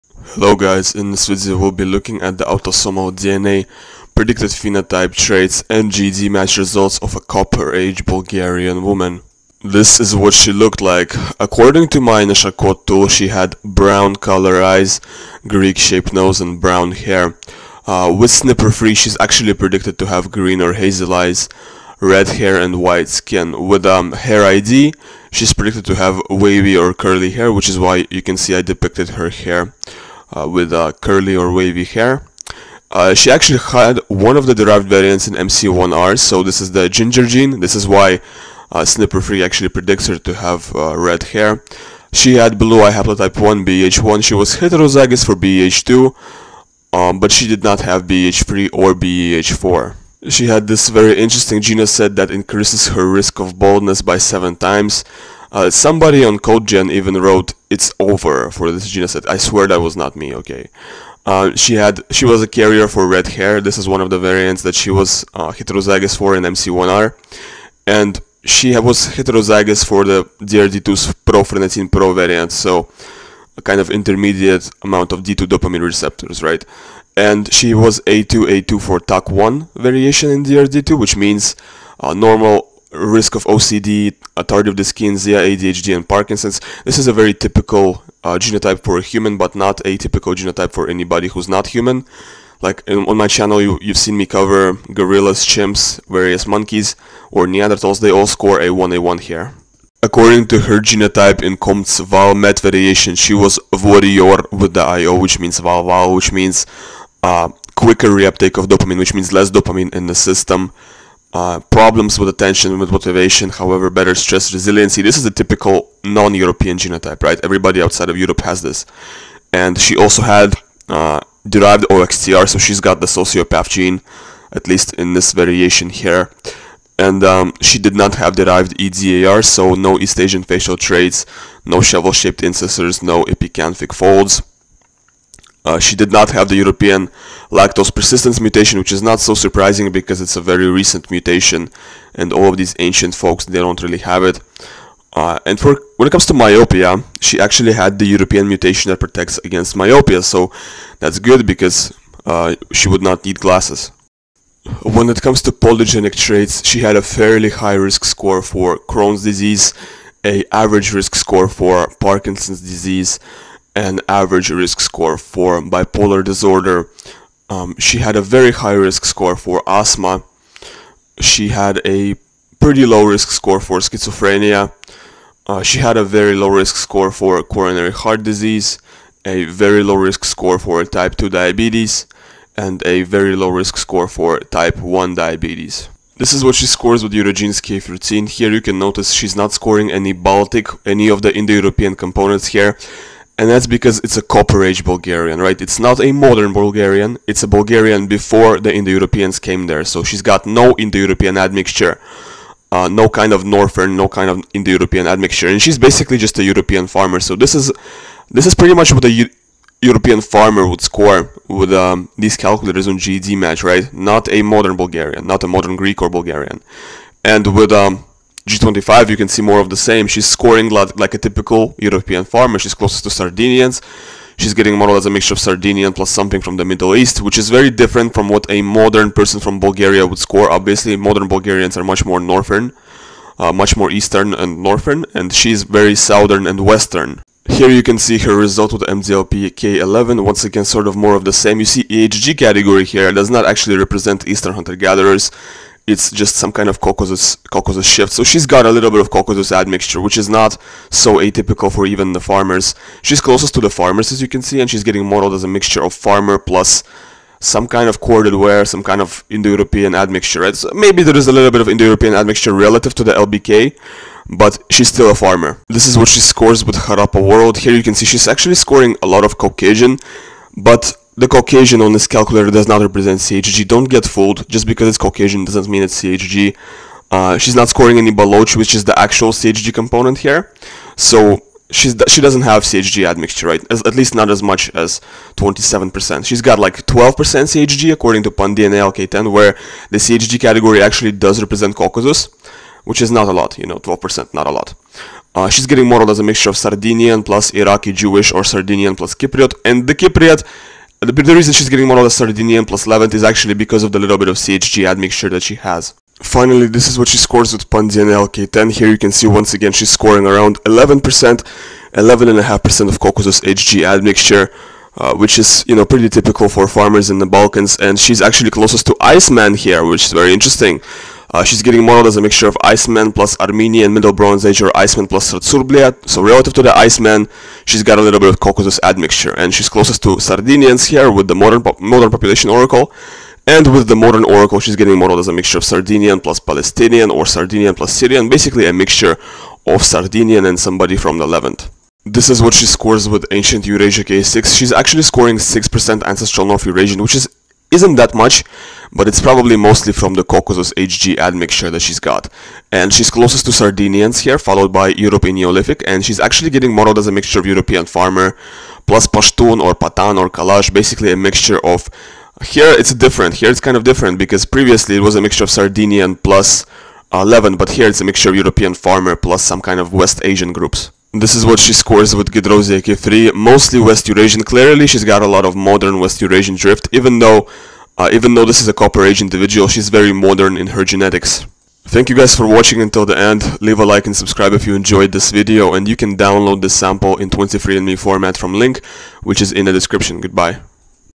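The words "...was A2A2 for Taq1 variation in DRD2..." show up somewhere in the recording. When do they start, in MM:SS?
01:17.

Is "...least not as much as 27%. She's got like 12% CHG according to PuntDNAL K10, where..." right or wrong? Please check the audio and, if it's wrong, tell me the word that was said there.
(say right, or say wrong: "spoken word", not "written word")
right.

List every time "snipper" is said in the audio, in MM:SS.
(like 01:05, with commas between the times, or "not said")
00:18, 00:38.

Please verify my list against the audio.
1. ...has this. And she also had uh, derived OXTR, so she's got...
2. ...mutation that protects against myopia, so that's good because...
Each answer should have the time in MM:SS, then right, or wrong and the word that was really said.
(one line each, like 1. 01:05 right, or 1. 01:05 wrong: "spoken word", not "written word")
1. 01:58 right
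2. 02:28 right.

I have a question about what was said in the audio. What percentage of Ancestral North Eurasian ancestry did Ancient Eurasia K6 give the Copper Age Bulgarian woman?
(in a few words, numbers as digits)
6%.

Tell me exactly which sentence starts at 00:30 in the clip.
Uh, with uh, curly or wavy hair.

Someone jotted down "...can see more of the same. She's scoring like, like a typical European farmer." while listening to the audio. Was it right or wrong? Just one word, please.
right.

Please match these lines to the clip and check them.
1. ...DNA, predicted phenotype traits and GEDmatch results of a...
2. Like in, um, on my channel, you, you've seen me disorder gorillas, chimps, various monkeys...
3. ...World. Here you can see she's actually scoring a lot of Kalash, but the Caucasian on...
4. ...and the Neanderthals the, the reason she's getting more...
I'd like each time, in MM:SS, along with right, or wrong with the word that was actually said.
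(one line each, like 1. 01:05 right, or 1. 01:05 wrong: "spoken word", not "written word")
1. 00:03 right
2. 01:32 wrong: "cover", not "disorder"
3. 04:27 wrong: "Caucasian", not "Kalash"
4. 04:59 wrong: "Cypriot", not "Neanderthals".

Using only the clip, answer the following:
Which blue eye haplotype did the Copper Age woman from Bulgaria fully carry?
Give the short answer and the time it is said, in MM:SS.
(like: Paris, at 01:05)
BH1, at 00:43.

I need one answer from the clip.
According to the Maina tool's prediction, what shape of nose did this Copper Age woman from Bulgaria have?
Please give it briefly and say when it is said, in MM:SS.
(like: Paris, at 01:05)
Greek-shaped, at 00:15.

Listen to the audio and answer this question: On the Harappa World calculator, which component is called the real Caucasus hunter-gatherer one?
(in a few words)
Baloch.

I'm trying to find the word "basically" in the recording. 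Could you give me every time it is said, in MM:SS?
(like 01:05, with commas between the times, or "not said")
03:25, 05:38, 06:00.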